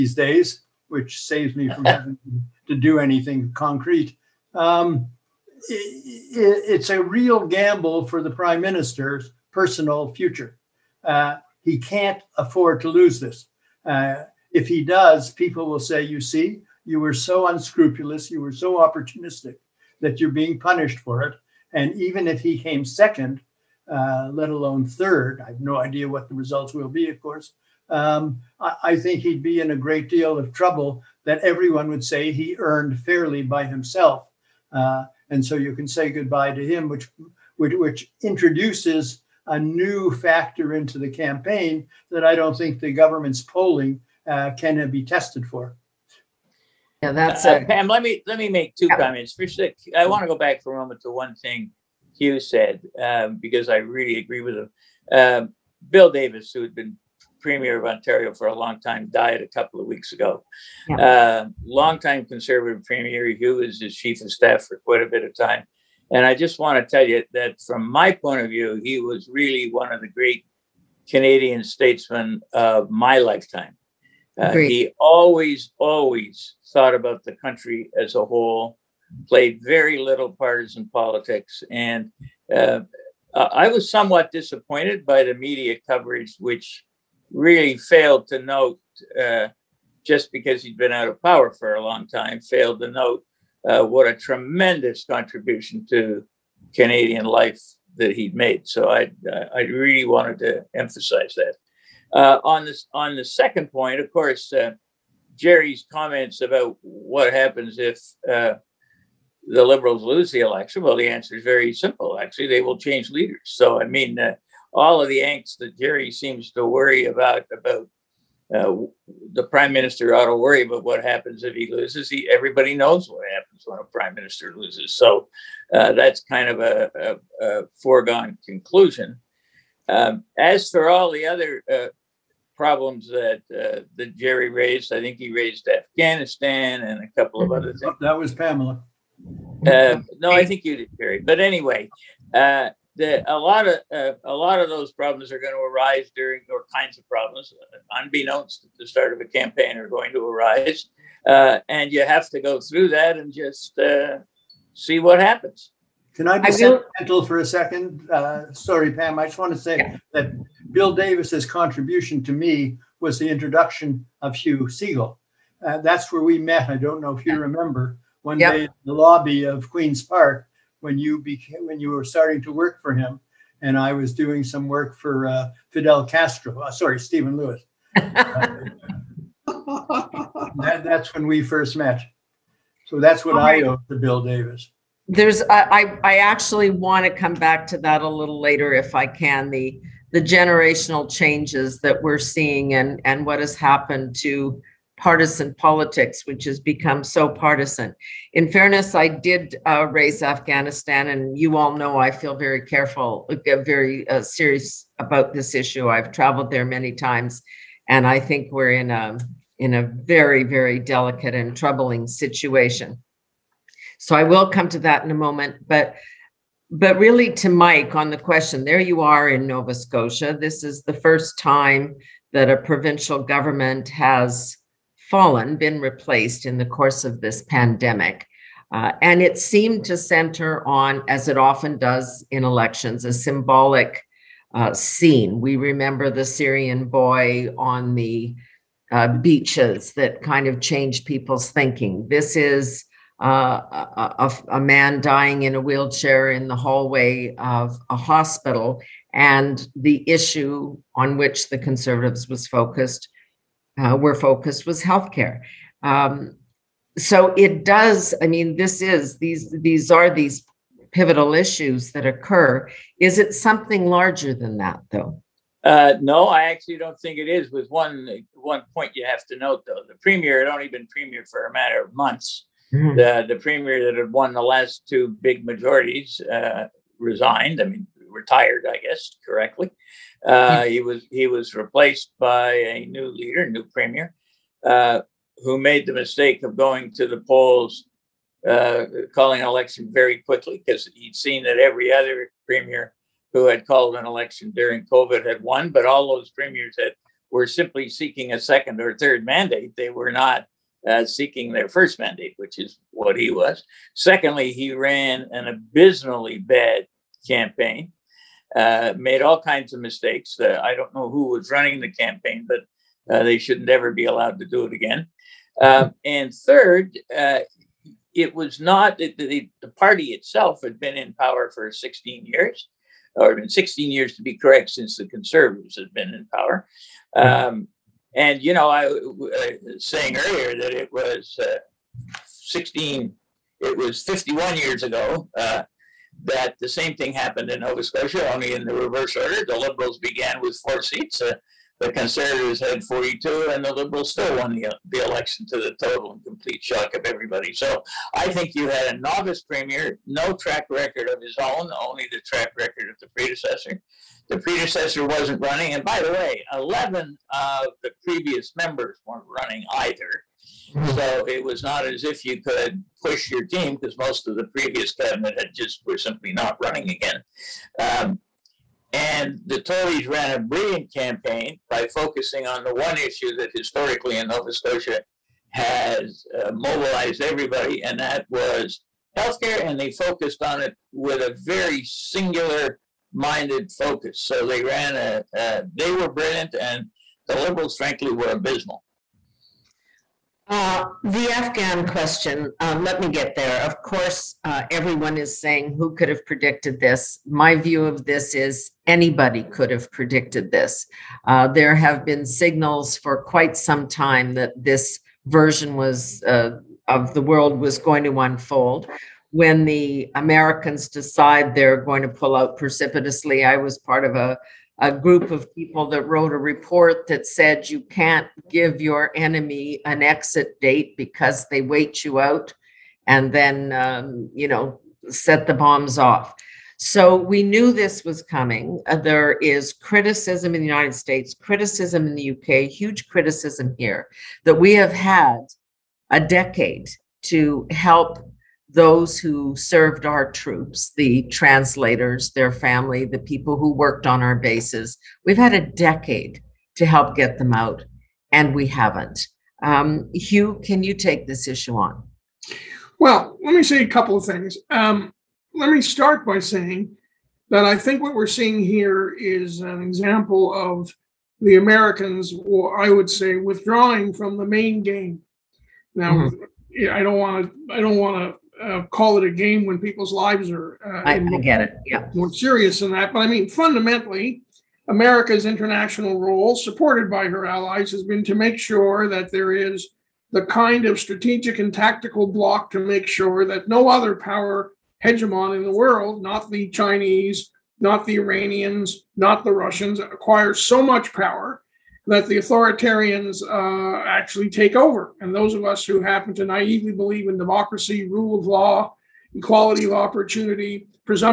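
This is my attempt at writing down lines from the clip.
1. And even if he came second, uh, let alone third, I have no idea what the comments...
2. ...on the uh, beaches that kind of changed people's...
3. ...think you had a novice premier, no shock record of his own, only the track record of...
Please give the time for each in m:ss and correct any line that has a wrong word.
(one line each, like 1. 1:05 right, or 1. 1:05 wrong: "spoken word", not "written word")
1. 0:21 wrong: "results", not "comments"
2. 3:57 right
3. 5:48 wrong: "track", not "shock".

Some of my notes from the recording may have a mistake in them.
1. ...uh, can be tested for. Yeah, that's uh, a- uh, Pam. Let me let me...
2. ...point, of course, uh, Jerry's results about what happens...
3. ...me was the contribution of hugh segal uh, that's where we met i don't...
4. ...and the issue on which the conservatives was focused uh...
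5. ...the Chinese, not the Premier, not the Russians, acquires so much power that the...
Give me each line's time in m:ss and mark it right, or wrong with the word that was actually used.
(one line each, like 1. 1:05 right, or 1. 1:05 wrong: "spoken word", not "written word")
1. 0:44 right
2. 1:43 wrong: "comments", not "results"
3. 2:42 wrong: "introduction", not "contribution"
4. 4:09 right
5. 8:06 wrong: "Iranians", not "Premier".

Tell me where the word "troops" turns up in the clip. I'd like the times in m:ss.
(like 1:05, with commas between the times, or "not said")
7:20.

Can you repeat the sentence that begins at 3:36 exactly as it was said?
But really, to Mike on the question, there you are in Nova Scotia.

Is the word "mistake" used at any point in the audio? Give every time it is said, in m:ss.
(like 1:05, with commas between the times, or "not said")
4:45, 5:09.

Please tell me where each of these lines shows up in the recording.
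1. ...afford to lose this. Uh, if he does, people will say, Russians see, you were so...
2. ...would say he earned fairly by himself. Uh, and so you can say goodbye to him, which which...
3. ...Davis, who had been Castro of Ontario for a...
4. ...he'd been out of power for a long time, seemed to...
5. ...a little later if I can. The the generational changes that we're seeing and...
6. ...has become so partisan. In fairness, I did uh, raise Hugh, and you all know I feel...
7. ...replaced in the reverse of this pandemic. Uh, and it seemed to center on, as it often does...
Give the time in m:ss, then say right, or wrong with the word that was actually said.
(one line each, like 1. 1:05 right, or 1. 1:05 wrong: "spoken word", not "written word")
1. 0:12 wrong: "You", not "Russians"
2. 0:31 right
3. 0:56 wrong: "Premier", not "Castro"
4. 1:30 wrong: "failed", not "seemed"
5. 3:08 right
6. 3:16 wrong: "Afghanistan", not "Hugh"
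7. 3:45 wrong: "course", not "reverse".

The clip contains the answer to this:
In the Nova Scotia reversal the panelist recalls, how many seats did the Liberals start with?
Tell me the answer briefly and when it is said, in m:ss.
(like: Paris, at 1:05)
4, at 5:40.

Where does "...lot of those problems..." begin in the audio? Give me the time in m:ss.
2:24.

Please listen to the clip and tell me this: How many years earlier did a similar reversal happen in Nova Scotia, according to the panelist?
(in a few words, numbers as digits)
51.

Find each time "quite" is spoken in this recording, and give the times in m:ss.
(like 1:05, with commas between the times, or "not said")
1:04, 6:43.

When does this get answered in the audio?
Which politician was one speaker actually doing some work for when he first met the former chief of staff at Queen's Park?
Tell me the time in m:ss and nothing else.
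2:56.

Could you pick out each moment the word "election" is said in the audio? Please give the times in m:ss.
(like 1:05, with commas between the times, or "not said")
1:50, 3:52, 4:49, 4:54, 5:44.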